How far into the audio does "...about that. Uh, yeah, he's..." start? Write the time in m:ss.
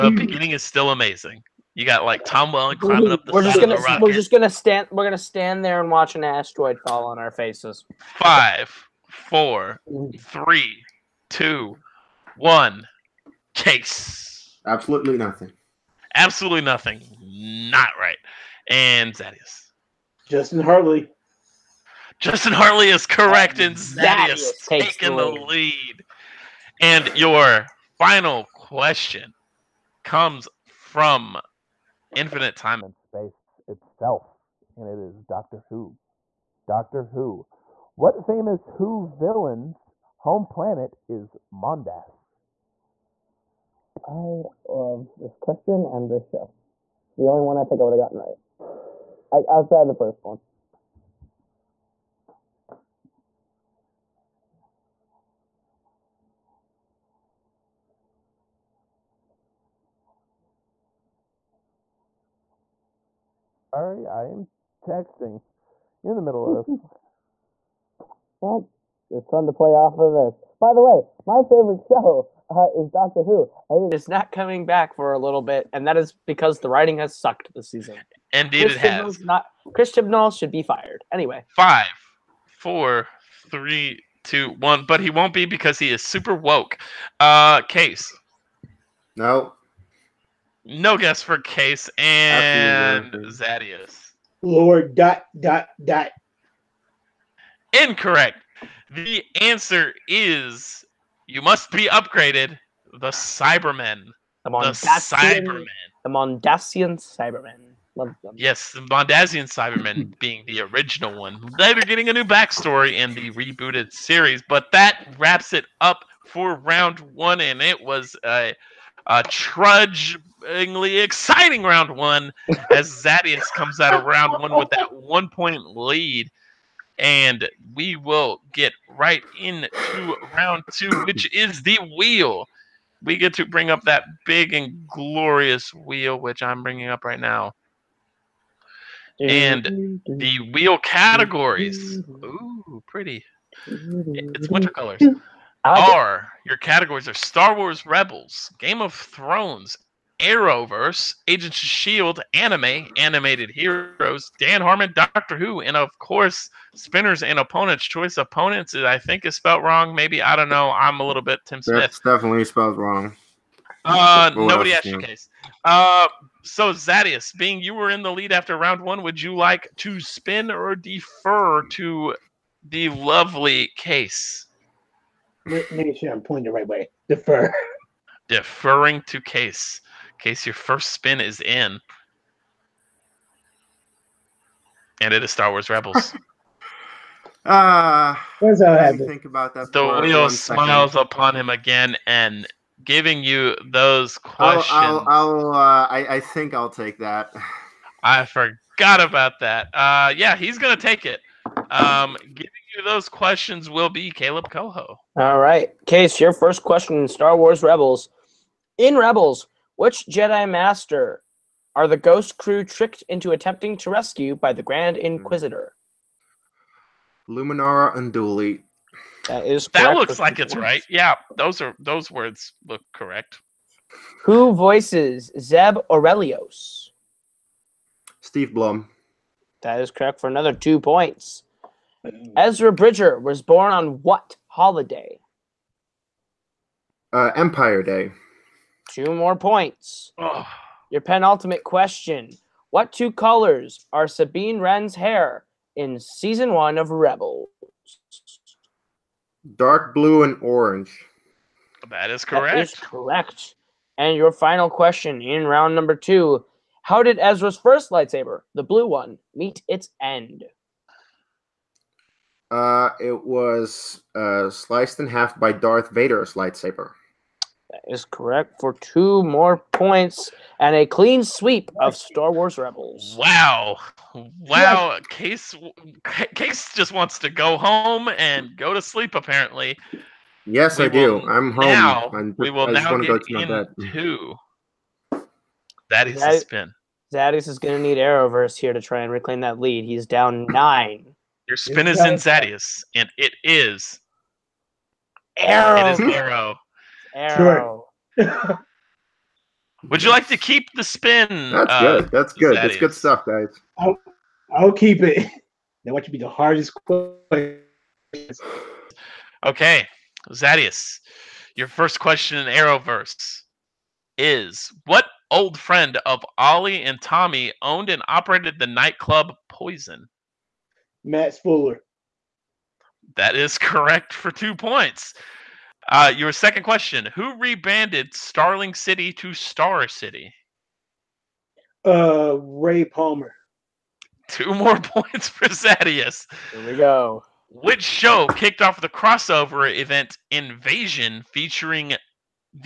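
3:19.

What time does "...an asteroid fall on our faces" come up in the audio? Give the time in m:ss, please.
0:06.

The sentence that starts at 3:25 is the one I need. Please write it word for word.
All right, Kees, your first question in Star Wars Rebels.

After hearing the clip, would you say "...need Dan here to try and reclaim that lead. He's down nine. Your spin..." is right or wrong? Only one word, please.
wrong.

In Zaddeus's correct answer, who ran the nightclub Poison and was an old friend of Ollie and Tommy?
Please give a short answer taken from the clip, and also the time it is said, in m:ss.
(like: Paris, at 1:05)
Matt Fuller, at 5:21.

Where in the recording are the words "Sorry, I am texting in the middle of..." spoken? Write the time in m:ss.
1:03.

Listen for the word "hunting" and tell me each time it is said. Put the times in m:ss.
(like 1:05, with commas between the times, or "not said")
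not said.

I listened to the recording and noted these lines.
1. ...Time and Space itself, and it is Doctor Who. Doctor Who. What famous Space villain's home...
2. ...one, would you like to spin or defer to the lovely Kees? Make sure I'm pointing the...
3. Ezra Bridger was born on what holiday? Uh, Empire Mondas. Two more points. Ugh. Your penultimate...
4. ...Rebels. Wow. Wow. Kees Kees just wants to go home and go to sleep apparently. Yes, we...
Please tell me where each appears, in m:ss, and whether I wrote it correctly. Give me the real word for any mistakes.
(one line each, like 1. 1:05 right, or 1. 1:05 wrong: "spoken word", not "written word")
1. 0:32 wrong: "Who", not "Space"
2. 2:48 right
3. 3:52 wrong: "Day", not "Mondas"
4. 4:32 right.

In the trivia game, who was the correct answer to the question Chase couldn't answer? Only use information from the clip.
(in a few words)
Justin Hartley.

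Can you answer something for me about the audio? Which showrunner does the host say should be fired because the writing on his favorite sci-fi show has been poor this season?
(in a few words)
Chris Chibnall.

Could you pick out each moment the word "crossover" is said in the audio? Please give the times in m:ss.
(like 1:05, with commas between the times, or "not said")
5:38.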